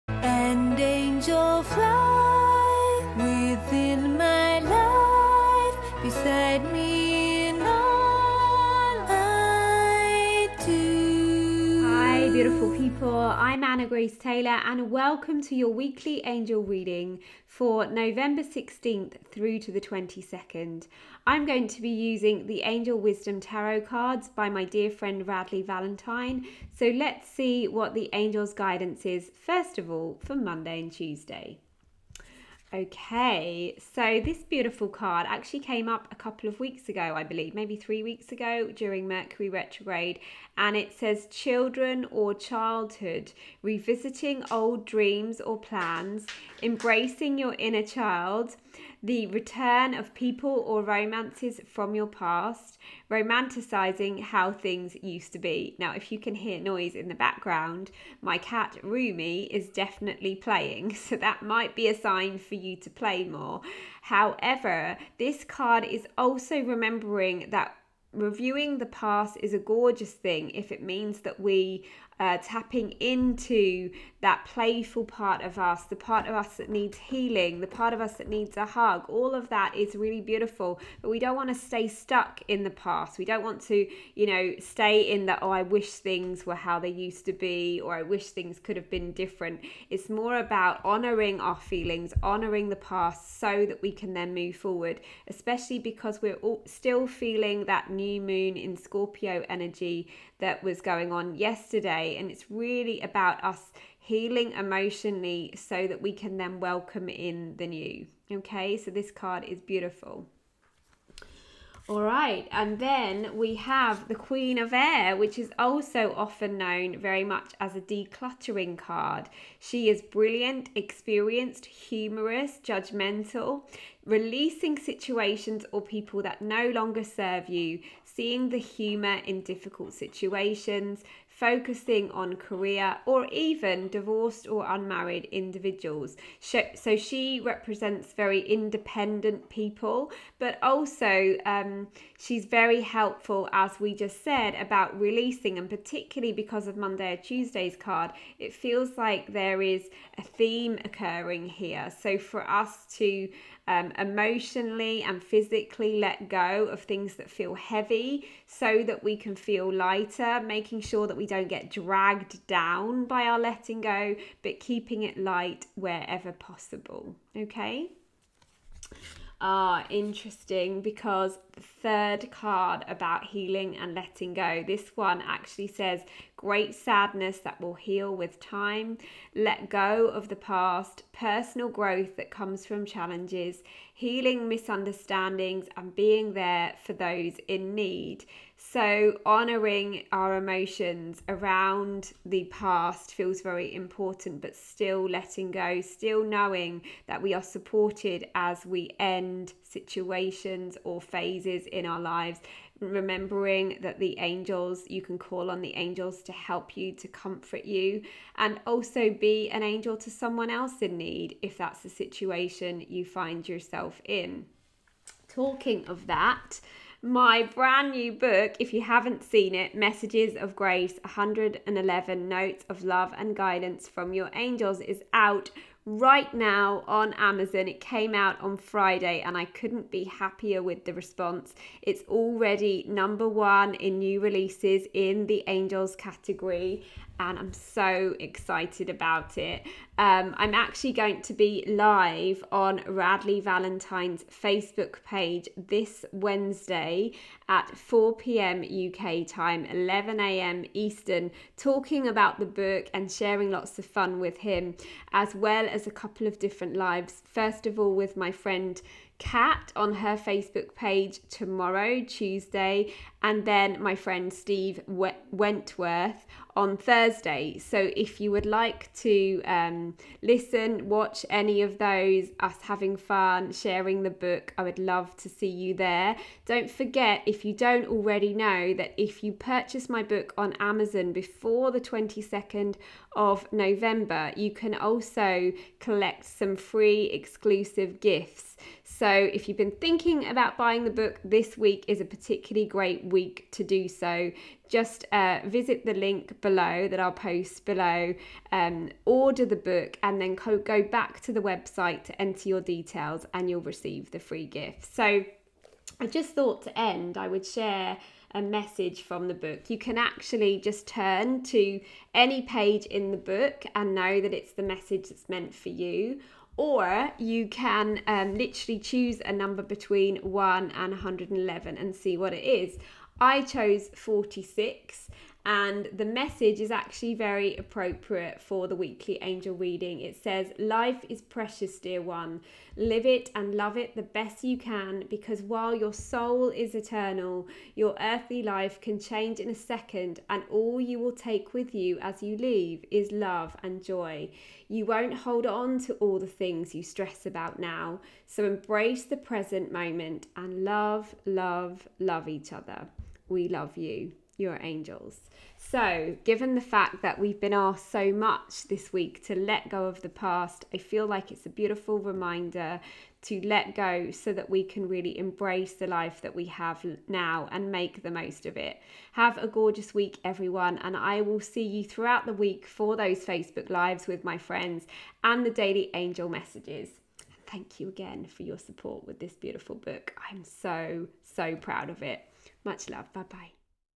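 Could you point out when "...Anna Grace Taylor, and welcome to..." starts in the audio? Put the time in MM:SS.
00:13.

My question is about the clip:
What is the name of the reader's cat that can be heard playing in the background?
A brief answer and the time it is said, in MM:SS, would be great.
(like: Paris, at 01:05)
Rumi, at 00:58.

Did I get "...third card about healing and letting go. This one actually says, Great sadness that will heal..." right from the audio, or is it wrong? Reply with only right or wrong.
right.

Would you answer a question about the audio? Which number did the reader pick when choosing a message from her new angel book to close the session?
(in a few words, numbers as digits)
46.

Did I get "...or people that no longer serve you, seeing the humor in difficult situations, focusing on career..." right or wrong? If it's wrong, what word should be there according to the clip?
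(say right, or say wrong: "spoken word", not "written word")
right.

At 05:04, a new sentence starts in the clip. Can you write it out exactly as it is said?
So I just thought to end, I would share a message from the book.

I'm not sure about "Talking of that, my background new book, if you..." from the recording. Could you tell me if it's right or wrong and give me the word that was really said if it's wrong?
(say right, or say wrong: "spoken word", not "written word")
wrong: "brand", not "background".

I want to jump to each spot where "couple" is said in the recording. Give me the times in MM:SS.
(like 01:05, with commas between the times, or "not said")
00:36, 04:15.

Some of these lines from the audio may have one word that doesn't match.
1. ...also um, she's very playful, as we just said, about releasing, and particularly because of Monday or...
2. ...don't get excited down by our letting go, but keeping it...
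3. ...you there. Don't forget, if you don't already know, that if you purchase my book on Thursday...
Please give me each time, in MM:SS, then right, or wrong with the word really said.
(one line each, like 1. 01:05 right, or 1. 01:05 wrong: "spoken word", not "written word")
1. 02:20 wrong: "helpful", not "playful"
2. 02:41 wrong: "dragged", not "excited"
3. 04:35 wrong: "Amazon", not "Thursday".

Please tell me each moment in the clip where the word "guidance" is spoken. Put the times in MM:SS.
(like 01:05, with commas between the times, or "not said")
00:28, 03:43.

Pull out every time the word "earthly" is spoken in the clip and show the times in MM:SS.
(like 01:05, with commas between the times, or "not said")
05:37.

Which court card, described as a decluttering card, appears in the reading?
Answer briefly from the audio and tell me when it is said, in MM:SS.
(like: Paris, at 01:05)
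Queen of Air, at 01:54.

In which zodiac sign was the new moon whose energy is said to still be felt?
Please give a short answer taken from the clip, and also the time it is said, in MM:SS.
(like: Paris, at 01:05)
Scorpio, at 01:38.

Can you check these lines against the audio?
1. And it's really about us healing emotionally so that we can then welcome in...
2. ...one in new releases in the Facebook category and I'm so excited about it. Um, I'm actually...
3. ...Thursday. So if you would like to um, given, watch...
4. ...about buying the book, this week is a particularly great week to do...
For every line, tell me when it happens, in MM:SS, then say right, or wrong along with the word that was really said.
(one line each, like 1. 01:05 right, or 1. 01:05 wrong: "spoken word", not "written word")
1. 01:42 right
2. 03:53 wrong: "Angels", not "Facebook"
3. 04:26 wrong: "listen", not "given"
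4. 04:50 right.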